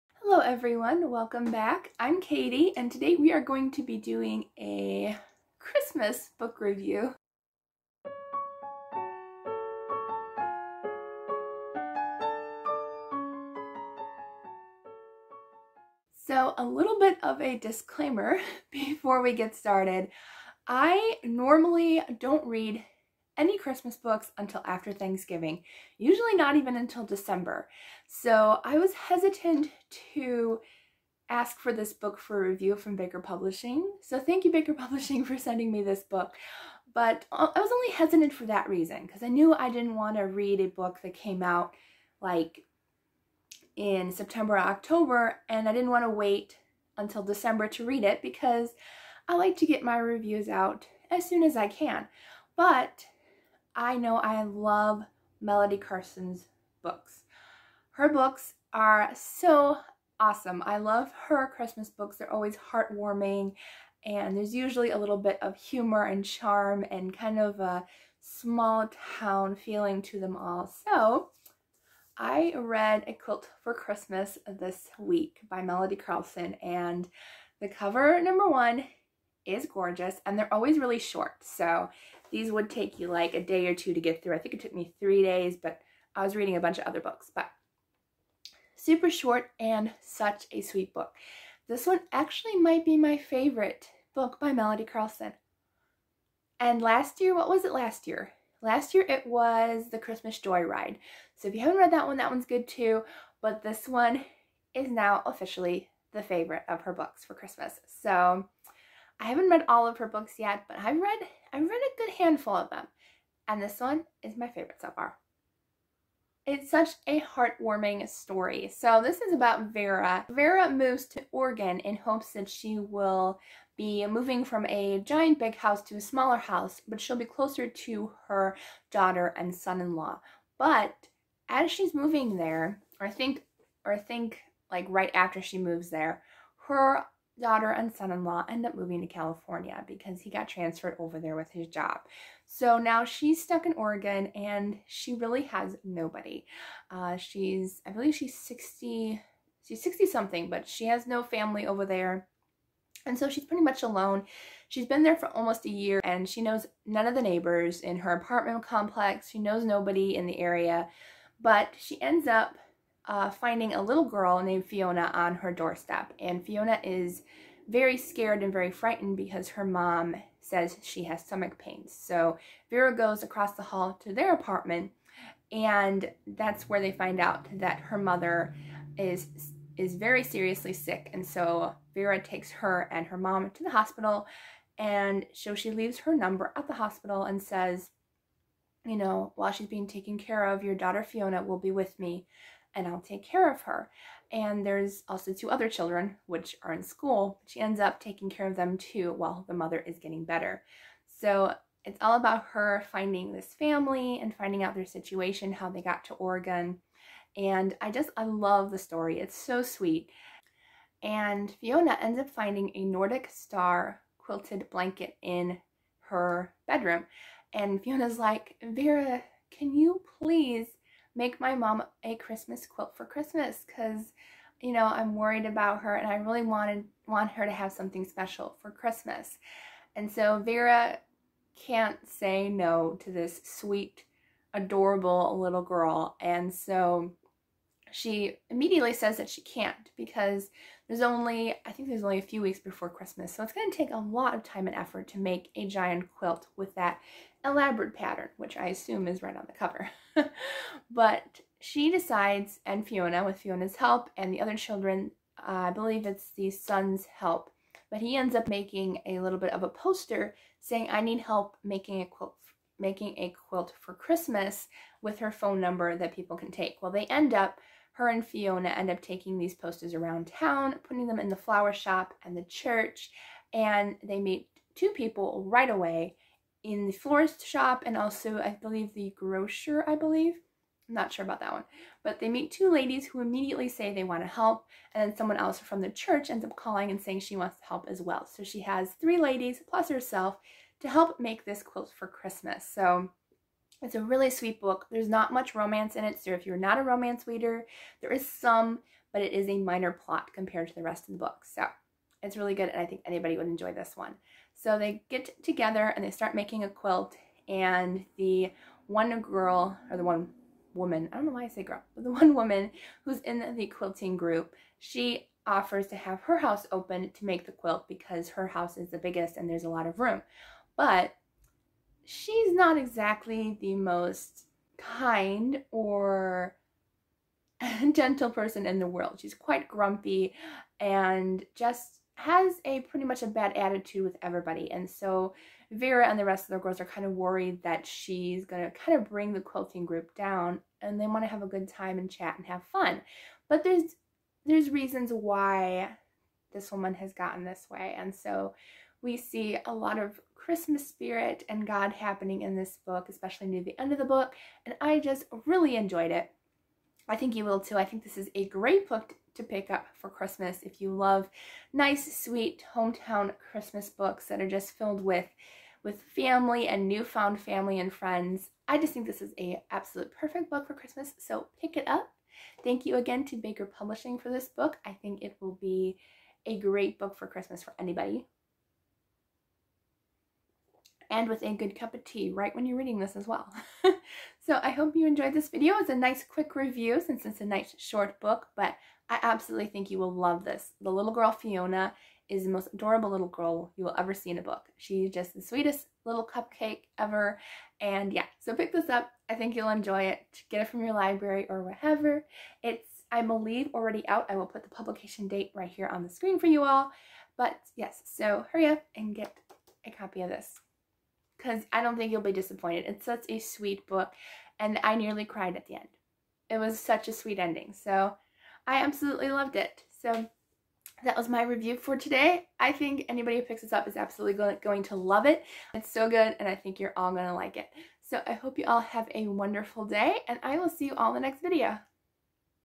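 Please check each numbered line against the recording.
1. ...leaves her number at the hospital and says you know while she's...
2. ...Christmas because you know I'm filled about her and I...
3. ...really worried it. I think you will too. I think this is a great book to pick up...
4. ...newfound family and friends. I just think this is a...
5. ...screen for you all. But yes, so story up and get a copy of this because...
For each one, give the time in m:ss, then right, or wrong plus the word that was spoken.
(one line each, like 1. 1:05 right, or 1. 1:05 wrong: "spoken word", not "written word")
1. 3:05 right
2. 3:43 wrong: "worried", not "filled"
3. 5:55 wrong: "enjoyed", not "worried"
4. 6:06 right
5. 6:46 wrong: "hurry", not "story".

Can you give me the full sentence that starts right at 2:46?
And Fiona is very scared and very frightened because her mom says she has stomach pains.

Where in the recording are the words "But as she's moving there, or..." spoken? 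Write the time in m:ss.
2:10.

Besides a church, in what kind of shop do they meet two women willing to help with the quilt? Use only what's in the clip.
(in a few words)
Florist shop.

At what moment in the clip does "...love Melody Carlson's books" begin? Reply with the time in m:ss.
0:54.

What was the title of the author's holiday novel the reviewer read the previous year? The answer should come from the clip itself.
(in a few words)
The Christmas Joyride.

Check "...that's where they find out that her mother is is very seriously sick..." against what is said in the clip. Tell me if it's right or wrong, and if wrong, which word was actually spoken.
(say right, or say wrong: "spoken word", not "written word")
right.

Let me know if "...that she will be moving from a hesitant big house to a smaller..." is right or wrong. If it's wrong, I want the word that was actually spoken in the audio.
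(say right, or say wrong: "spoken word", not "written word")
wrong: "giant", not "hesitant".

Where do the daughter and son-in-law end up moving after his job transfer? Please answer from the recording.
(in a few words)
California.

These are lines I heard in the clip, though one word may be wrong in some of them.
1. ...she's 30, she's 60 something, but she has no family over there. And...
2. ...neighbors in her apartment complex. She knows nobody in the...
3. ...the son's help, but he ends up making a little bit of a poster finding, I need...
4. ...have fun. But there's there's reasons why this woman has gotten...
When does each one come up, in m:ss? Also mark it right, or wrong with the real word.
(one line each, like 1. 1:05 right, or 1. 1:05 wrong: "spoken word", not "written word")
1. 2:28 wrong: "60", not "30"
2. 2:37 right
3. 4:16 wrong: "saying", not "finding"
4. 5:42 right.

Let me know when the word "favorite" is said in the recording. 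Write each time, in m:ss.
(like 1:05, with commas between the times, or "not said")
1:33, 1:46, 1:54.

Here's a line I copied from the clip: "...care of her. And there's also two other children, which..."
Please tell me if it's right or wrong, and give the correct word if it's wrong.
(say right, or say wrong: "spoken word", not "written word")
right.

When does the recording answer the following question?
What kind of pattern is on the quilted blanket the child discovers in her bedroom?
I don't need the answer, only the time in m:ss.
3:32.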